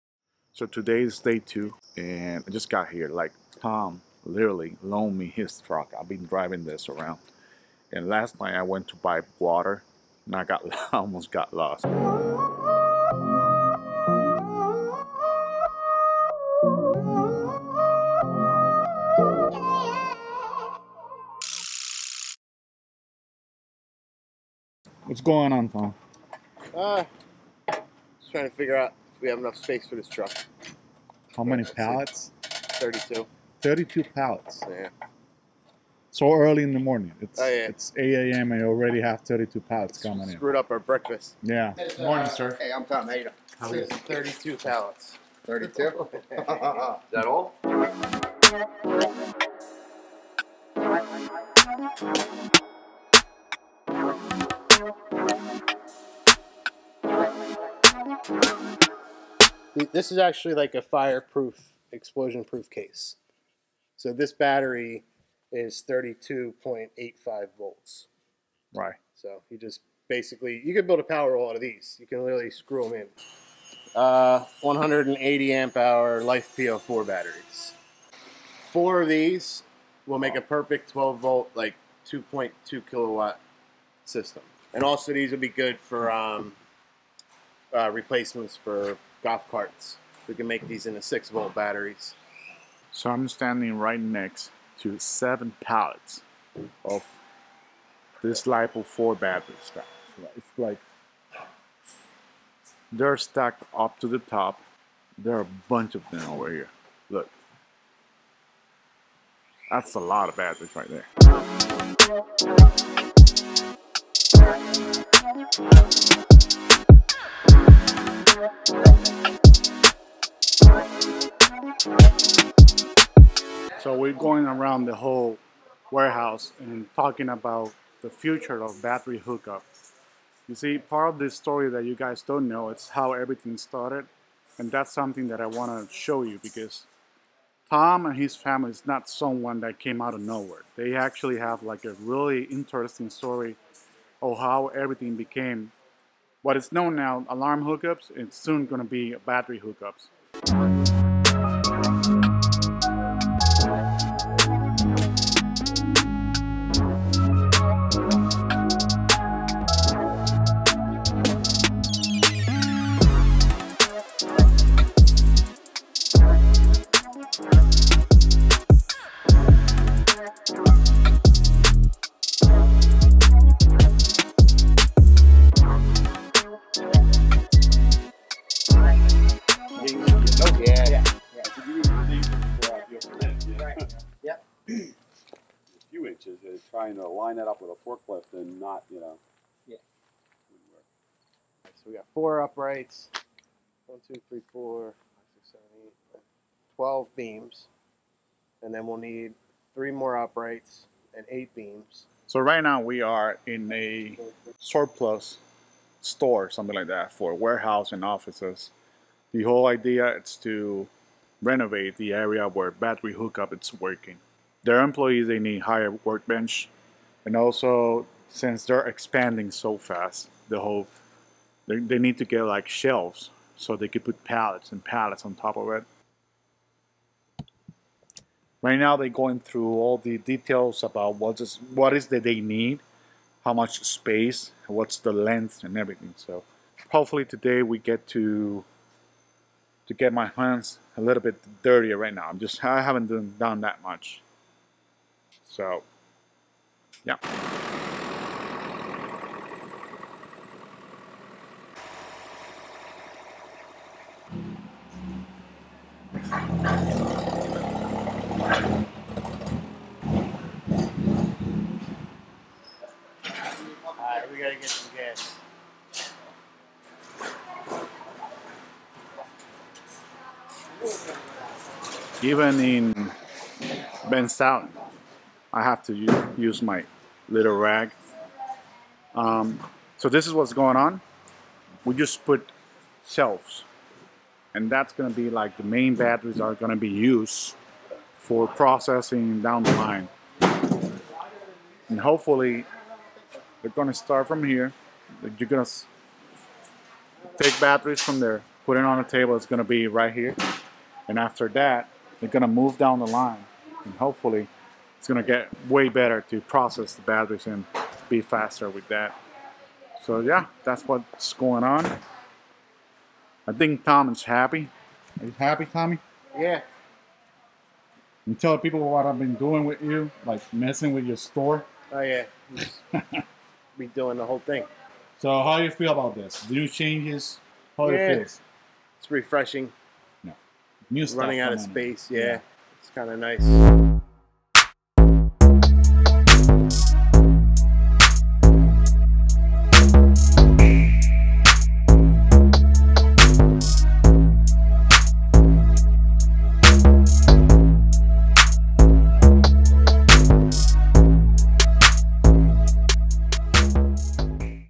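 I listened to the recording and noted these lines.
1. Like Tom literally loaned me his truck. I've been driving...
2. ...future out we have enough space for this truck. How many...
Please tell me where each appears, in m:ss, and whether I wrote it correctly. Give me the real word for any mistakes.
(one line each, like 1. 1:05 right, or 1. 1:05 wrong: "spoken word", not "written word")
1. 0:03 right
2. 0:28 wrong: "figure", not "future".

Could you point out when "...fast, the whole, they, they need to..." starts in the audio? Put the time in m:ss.
3:39.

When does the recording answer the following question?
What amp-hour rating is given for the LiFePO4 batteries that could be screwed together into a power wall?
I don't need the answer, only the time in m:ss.
1:14.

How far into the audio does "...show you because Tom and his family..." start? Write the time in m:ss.
2:15.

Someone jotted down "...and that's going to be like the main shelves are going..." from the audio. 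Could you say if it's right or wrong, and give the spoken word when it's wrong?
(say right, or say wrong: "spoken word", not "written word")
wrong: "batteries", not "shelves".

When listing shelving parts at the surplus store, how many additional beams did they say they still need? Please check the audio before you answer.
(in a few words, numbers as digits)
8.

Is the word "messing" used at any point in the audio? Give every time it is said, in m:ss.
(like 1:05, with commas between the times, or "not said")
5:20.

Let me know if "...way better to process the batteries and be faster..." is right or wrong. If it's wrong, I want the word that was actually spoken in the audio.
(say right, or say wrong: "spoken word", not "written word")
right.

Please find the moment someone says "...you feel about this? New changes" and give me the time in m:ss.
5:25.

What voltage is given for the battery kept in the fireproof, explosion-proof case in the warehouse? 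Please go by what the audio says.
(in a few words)
32.85 volts.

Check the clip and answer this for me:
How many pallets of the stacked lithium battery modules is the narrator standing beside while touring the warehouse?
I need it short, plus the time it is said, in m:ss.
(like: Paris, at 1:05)
7, at 1:34.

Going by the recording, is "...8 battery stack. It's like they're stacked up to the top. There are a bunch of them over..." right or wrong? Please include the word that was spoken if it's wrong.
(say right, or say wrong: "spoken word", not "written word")
wrong: "4", not "8".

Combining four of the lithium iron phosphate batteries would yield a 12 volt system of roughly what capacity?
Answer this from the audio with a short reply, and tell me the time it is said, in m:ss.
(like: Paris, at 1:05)
2.2 kilowatt, at 1:22.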